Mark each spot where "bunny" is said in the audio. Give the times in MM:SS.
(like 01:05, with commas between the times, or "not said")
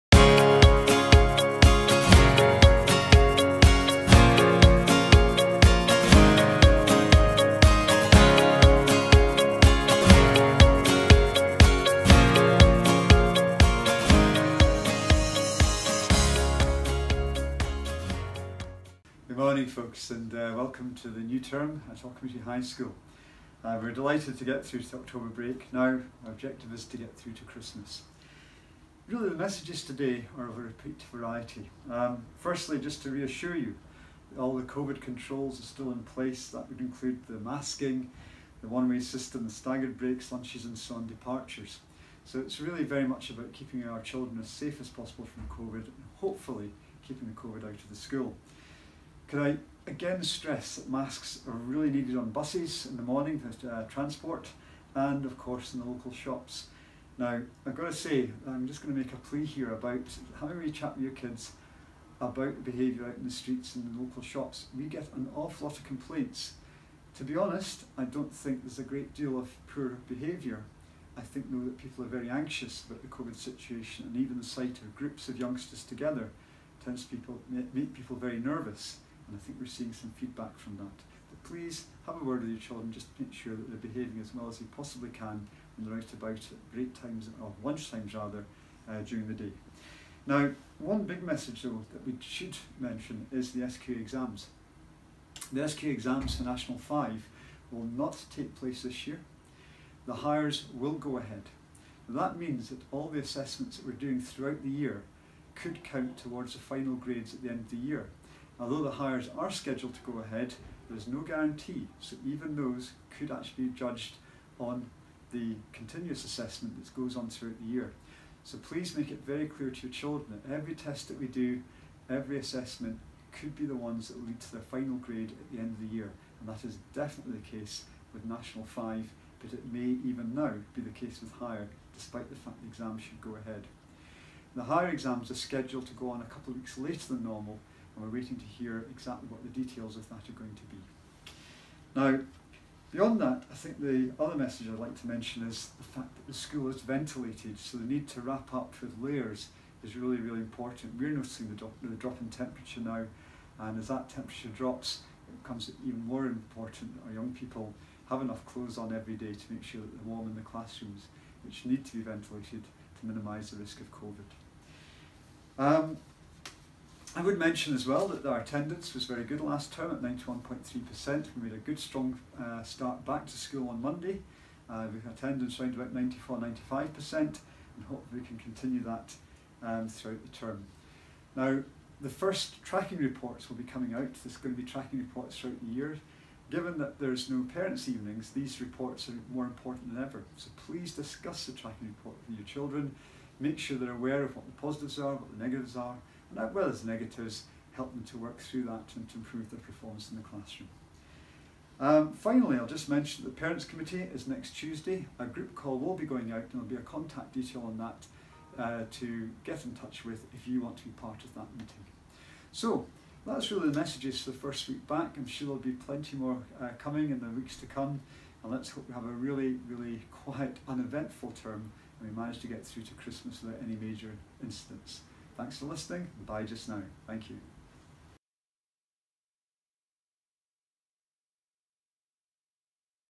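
not said.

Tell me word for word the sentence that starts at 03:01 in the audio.
Now, the first tracking reports will be coming out.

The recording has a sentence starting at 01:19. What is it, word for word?
And I think we're seeing some feedback from that.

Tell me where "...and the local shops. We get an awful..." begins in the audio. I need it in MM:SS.
01:03.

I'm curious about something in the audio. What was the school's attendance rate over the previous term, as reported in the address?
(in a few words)
91.3%.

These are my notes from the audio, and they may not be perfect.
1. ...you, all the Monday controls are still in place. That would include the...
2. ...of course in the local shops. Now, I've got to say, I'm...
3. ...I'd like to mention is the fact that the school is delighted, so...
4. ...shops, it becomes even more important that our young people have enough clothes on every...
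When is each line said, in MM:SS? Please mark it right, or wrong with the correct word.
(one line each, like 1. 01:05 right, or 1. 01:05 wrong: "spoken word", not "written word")
1. 00:33 wrong: "COVID", not "Monday"
2. 00:55 right
3. 02:24 wrong: "ventilated", not "delighted"
4. 02:34 wrong: "drops", not "shops".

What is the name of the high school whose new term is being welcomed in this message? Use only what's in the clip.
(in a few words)
Auchmuty High School.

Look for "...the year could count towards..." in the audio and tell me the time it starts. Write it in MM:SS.
01:44.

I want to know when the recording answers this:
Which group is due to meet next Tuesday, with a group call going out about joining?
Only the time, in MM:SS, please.
03:23.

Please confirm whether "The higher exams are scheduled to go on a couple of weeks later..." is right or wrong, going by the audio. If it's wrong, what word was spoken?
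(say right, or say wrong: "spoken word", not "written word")
right.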